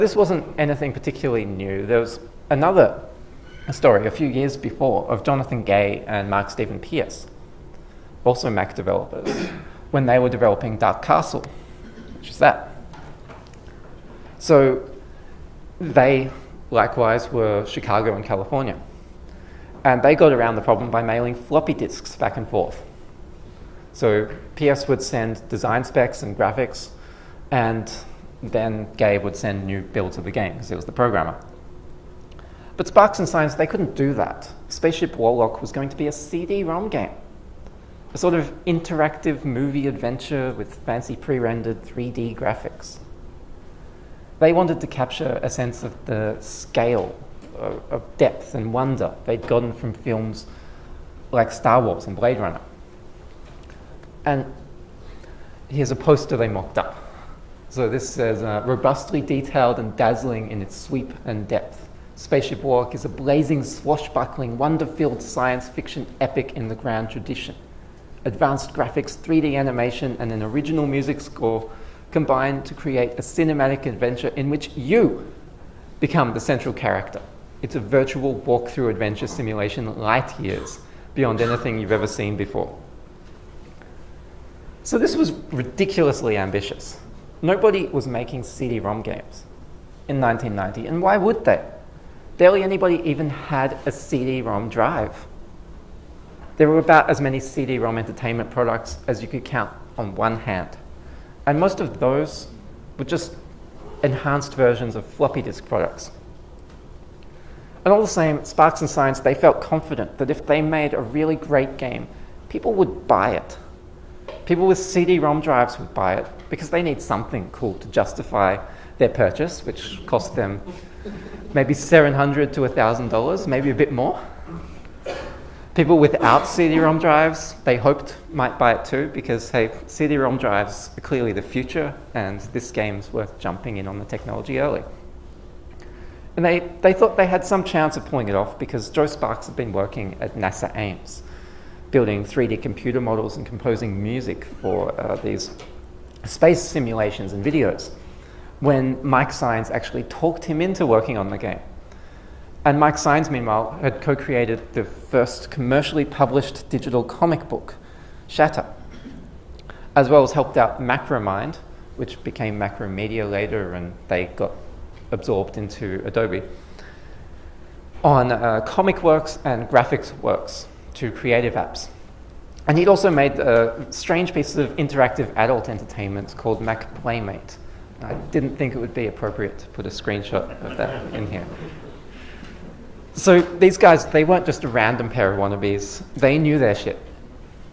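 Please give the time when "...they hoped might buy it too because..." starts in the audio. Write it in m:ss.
2:07.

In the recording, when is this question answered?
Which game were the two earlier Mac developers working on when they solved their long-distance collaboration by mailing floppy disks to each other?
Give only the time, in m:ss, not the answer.
0:10.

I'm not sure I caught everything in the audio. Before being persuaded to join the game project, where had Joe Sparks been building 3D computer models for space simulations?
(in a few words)
NASA Ames.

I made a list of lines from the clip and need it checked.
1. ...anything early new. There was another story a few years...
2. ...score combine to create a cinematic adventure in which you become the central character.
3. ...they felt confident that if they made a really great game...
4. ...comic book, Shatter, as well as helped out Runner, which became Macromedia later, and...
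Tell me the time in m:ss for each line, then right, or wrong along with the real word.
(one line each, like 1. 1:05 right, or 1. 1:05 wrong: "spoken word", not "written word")
1. 0:00 wrong: "particularly", not "early"
2. 1:11 right
3. 1:49 right
4. 2:37 wrong: "Macromind", not "Runner".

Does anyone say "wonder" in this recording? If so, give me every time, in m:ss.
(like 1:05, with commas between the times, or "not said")
0:48, 1:04.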